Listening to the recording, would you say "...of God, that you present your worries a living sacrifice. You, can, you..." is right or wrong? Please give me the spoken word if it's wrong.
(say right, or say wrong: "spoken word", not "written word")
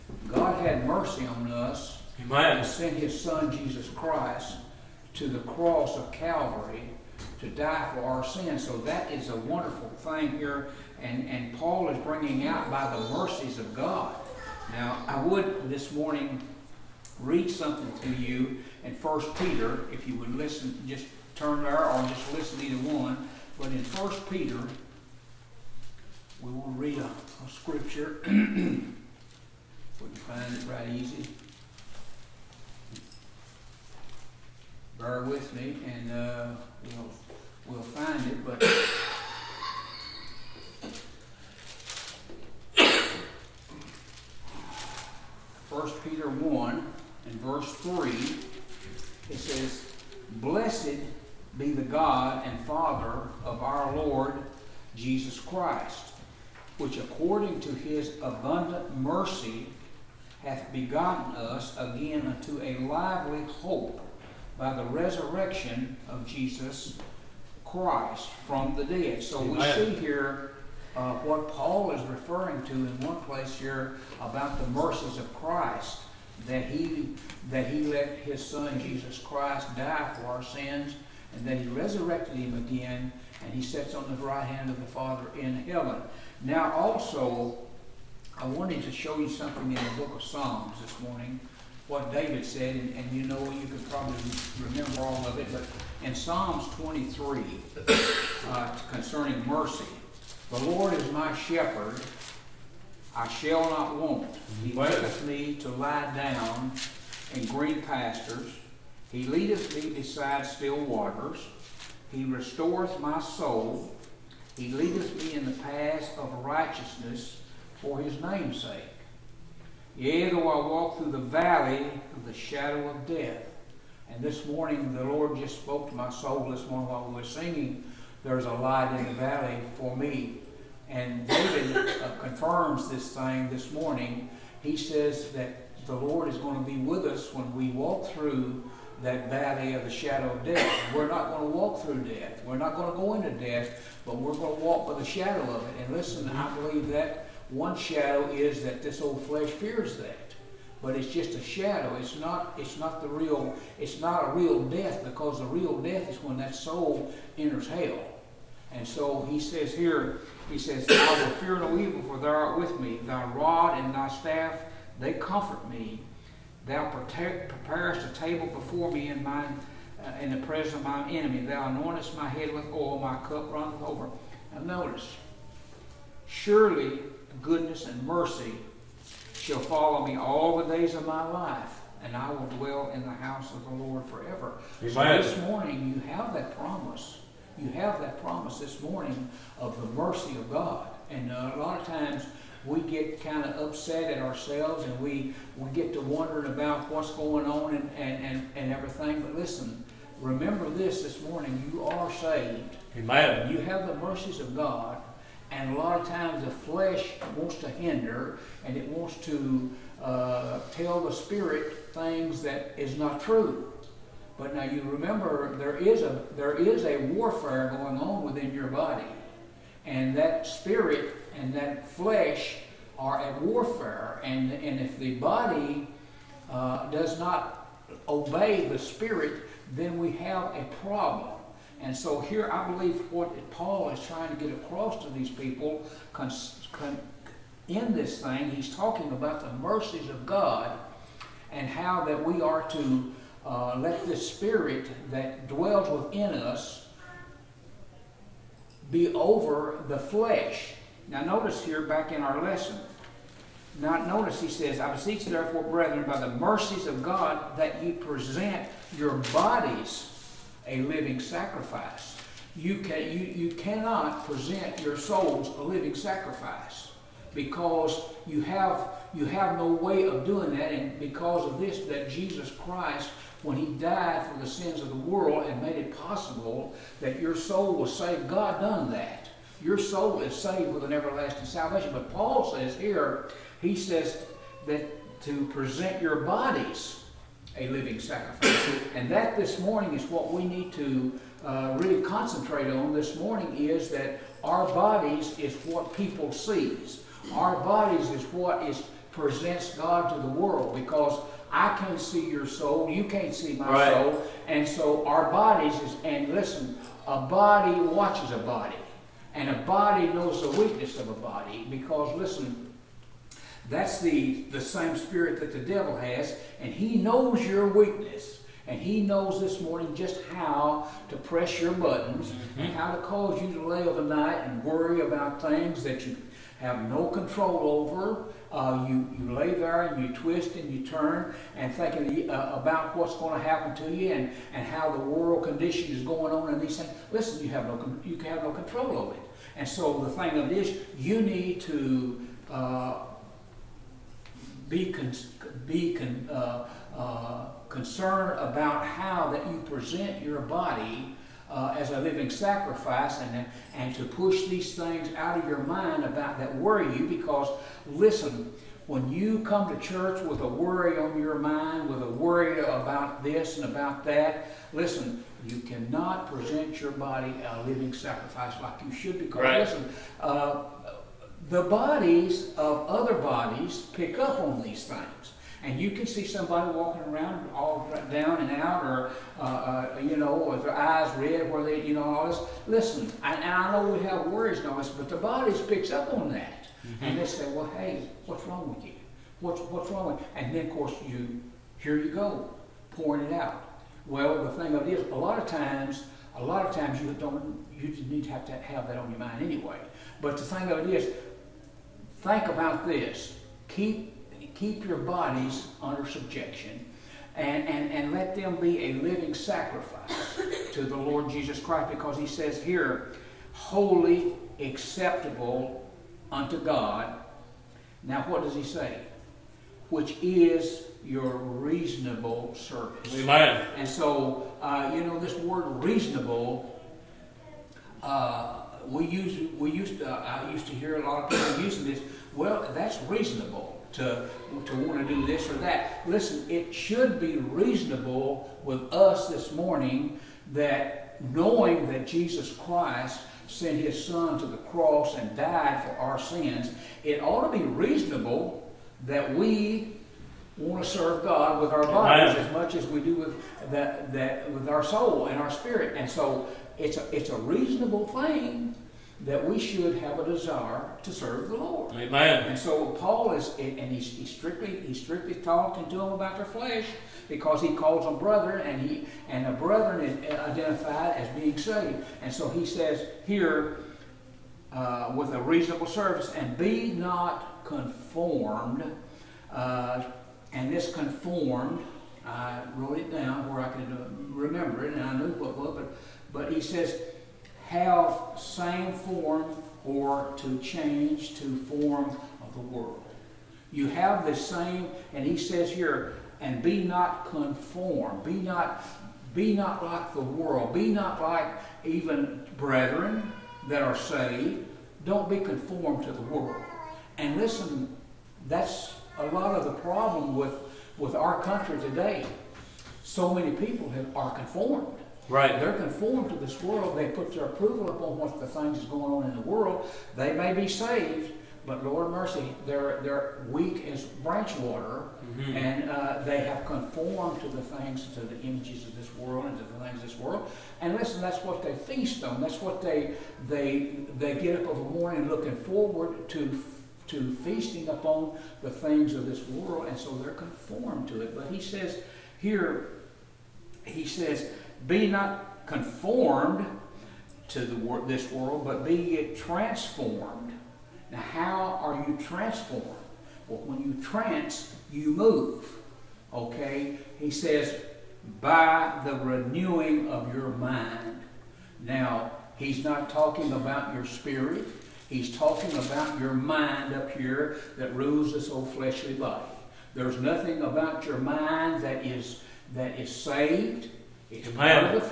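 wrong: "bodies", not "worries".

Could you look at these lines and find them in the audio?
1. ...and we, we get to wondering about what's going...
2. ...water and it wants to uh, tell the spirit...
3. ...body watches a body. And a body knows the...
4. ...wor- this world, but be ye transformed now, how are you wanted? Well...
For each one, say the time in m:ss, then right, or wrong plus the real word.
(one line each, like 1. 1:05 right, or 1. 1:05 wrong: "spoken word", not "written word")
1. 3:14 right
2. 3:27 wrong: "hinder", not "water"
3. 5:07 right
4. 9:07 wrong: "transformed", not "wanted".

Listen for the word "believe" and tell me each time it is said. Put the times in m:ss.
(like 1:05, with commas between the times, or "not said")
2:26, 3:52.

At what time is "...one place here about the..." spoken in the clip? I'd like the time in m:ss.
1:12.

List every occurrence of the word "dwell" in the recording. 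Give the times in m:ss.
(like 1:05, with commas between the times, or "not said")
3:02, 4:05.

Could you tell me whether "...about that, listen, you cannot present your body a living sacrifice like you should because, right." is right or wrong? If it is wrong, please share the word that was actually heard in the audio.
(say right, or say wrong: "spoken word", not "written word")
right.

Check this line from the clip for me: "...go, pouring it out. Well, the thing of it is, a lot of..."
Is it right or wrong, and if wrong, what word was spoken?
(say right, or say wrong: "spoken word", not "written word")
right.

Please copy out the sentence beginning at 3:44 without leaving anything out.
And, and if the body uh, does not obey the spirit, then we have a problem.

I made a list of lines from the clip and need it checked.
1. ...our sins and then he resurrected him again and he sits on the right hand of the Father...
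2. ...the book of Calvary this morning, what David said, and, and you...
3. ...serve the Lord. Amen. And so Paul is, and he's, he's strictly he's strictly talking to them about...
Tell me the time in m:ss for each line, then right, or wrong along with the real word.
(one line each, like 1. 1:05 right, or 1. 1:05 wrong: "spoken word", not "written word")
1. 1:20 right
2. 1:29 wrong: "Psalms", not "Calvary"
3. 7:41 right.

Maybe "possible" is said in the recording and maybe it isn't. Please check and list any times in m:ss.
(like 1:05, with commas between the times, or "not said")
4:35.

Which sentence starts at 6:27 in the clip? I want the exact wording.
And they say, well, hey, what's wrong with you?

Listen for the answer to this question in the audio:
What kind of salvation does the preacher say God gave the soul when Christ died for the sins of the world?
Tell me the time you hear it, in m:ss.
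4:40.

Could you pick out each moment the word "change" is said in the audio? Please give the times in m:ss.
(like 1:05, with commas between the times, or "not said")
8:10.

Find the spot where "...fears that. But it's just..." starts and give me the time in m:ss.
2:29.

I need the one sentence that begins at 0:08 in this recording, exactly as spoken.
So that is a wonderful thing here.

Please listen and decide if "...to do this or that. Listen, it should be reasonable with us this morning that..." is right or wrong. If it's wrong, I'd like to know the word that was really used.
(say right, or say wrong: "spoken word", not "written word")
right.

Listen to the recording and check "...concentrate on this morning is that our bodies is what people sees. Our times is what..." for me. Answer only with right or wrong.
wrong.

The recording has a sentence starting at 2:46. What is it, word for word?
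Thou preparest a table before me in mine, uh, in the presence of my enemy.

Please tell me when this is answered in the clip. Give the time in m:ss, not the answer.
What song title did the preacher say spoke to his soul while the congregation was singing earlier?
2:08.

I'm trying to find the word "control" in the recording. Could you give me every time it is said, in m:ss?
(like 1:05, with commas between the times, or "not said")
5:27, 5:38.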